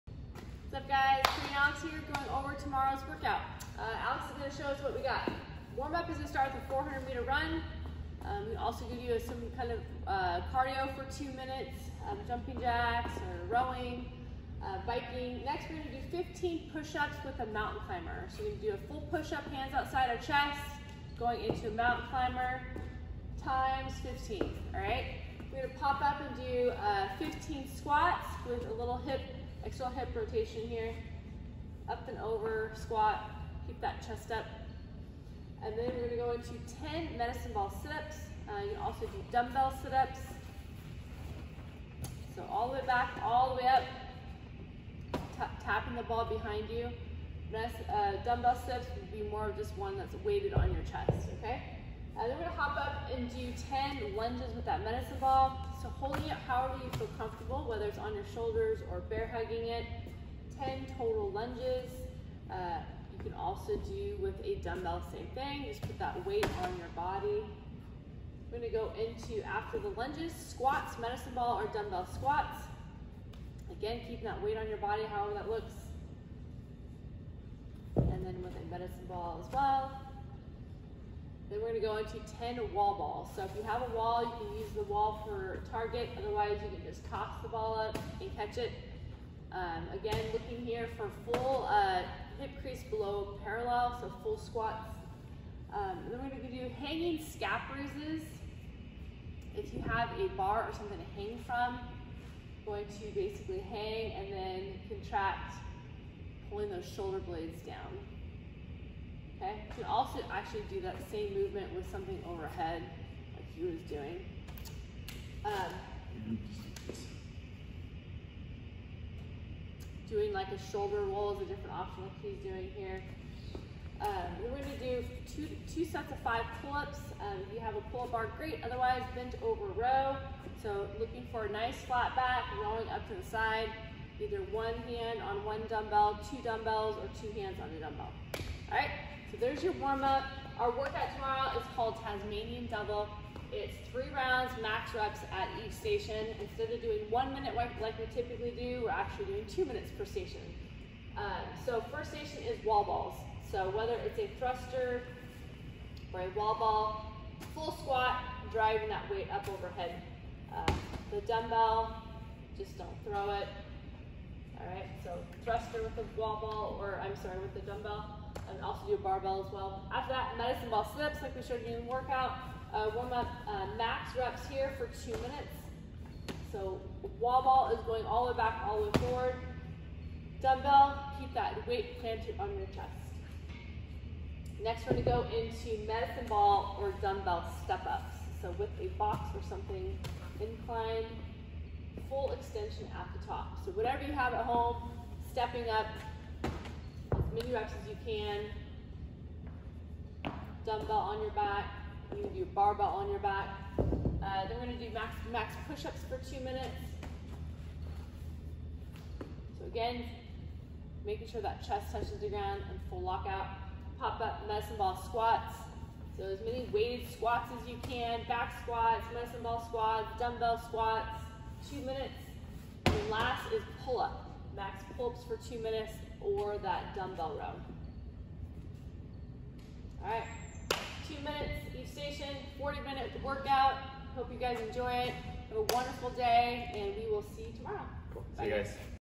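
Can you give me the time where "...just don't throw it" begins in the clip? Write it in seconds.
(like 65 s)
162 s.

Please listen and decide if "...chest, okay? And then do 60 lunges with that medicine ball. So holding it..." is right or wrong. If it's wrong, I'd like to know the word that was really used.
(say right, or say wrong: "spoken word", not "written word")
wrong: "10", not "60".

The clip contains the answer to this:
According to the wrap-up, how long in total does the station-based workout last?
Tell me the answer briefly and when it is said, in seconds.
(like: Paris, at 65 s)
40 minutes, at 232 s.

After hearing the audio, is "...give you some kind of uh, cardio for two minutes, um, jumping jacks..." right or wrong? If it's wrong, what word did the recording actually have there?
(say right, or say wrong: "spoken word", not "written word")
right.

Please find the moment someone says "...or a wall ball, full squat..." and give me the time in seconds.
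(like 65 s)
156 s.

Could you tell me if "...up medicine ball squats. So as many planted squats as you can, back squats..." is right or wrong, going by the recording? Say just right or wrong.
wrong.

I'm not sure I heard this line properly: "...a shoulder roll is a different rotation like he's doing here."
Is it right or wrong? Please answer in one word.
wrong.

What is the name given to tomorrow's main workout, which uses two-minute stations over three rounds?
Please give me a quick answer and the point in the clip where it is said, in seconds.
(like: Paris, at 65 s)
Tasmanian Double, at 142 s.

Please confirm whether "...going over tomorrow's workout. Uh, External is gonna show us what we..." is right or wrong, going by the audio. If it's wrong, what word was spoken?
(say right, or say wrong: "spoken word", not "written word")
wrong: "Alex", not "External".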